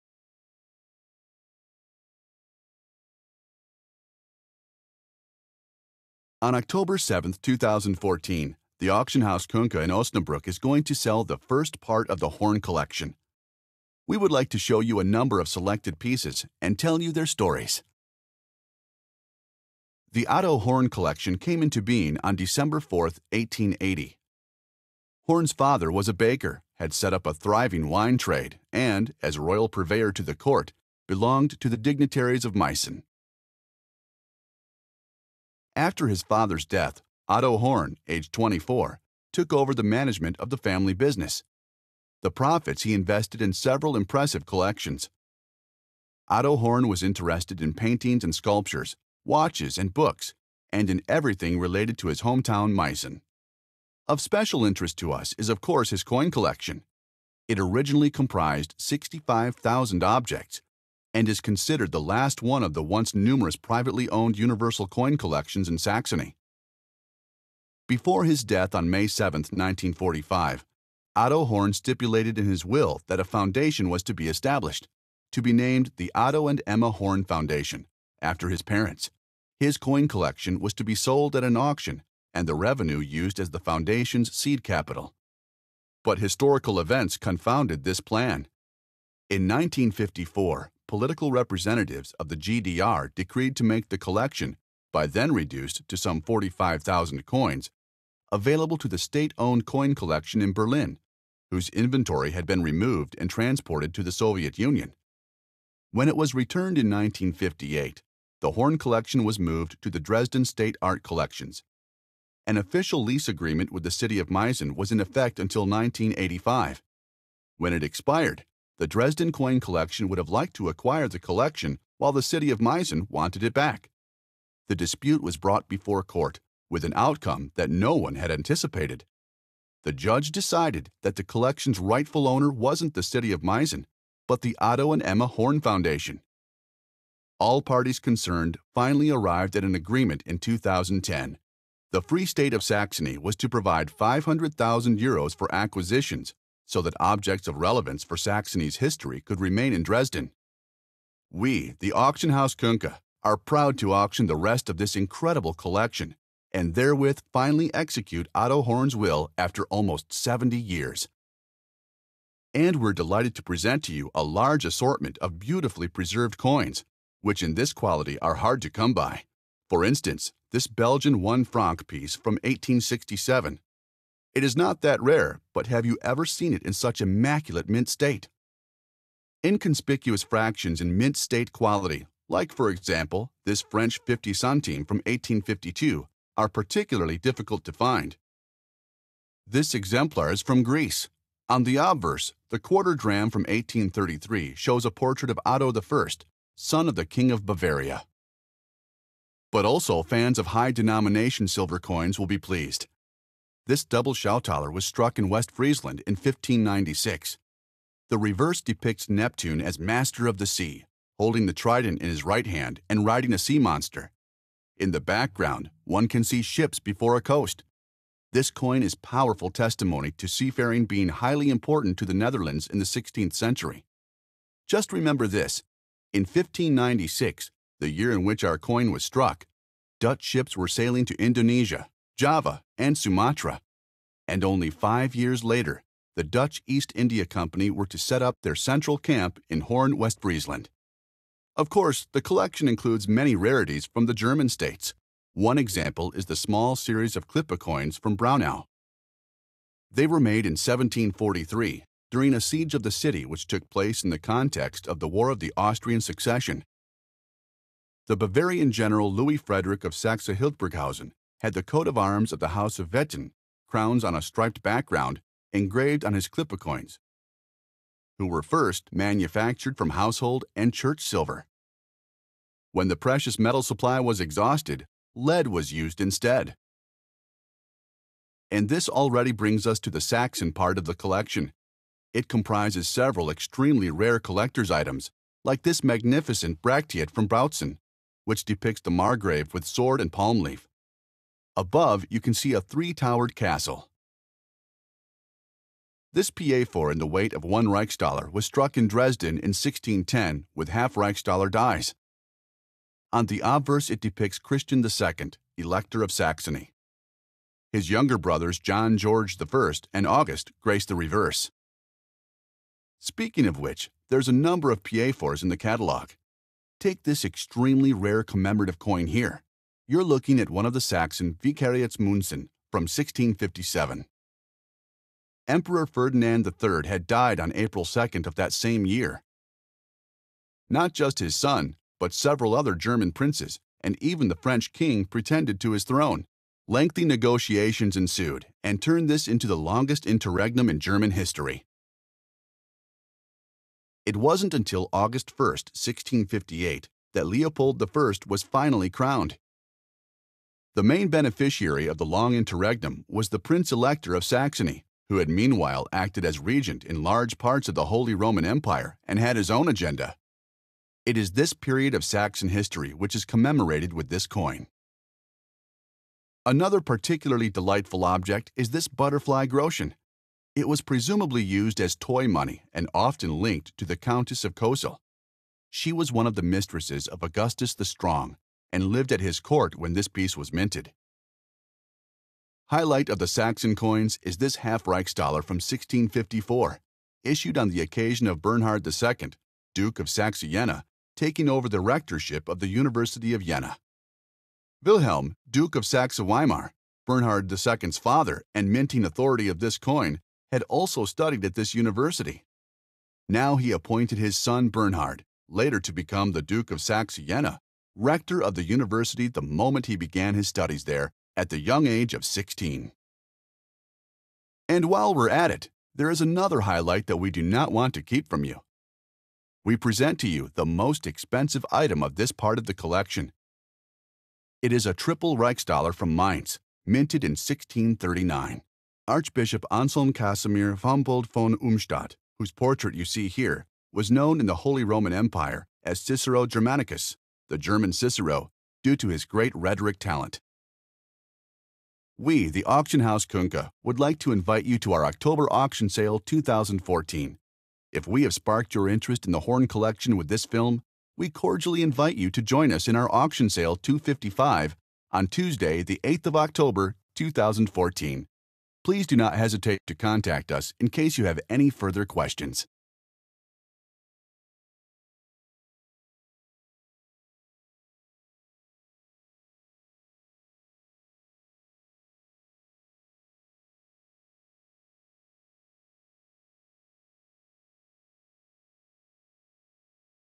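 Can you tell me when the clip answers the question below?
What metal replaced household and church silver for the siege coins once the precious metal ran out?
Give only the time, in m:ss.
4:35.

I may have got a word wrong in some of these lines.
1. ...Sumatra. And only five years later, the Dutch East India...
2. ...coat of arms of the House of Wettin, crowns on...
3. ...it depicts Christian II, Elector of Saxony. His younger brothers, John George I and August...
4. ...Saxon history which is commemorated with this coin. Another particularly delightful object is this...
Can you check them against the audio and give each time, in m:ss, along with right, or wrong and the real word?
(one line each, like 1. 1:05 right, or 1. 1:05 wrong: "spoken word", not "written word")
1. 3:52 right
2. 4:21 right
3. 5:03 right
4. 6:02 right.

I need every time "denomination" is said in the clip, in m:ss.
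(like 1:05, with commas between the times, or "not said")
3:20.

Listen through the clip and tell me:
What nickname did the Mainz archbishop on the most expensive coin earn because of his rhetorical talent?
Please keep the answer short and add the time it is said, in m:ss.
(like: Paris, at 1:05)
German Cicero, at 7:17.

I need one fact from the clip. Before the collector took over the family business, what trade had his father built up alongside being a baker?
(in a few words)
wine trade.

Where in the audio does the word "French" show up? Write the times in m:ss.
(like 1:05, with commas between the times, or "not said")
3:03, 5:34.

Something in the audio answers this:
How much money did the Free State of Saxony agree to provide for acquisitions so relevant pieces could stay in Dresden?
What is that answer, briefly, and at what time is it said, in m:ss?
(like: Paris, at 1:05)
500,000 euros, at 2:23.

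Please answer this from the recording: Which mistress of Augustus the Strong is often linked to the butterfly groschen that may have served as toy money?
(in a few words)
Countess of Kosel.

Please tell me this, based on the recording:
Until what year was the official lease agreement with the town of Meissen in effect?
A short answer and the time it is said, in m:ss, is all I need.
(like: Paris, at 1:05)
1985, at 1:55.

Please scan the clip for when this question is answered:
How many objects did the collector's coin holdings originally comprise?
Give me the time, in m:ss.
0:58.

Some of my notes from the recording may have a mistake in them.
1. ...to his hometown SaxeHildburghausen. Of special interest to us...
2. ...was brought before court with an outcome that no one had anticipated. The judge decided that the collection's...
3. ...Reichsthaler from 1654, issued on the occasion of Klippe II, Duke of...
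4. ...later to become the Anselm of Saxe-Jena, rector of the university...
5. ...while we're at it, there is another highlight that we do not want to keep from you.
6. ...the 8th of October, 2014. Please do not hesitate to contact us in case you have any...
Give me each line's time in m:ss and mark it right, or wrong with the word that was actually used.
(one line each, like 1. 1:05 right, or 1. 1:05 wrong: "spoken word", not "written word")
1. 0:51 wrong: "Meissen", not "SaxeHildburghausen"
2. 2:05 right
3. 6:24 wrong: "Bernhard", not "Klippe"
4. 6:45 wrong: "Duke", not "Anselm"
5. 6:54 right
6. 7:35 right.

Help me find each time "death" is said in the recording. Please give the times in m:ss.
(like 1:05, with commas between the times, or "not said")
0:36, 1:08.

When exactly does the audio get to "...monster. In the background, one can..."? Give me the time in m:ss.
3:33.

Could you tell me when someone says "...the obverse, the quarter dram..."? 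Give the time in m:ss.
3:11.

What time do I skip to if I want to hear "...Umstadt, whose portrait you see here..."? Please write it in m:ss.
7:11.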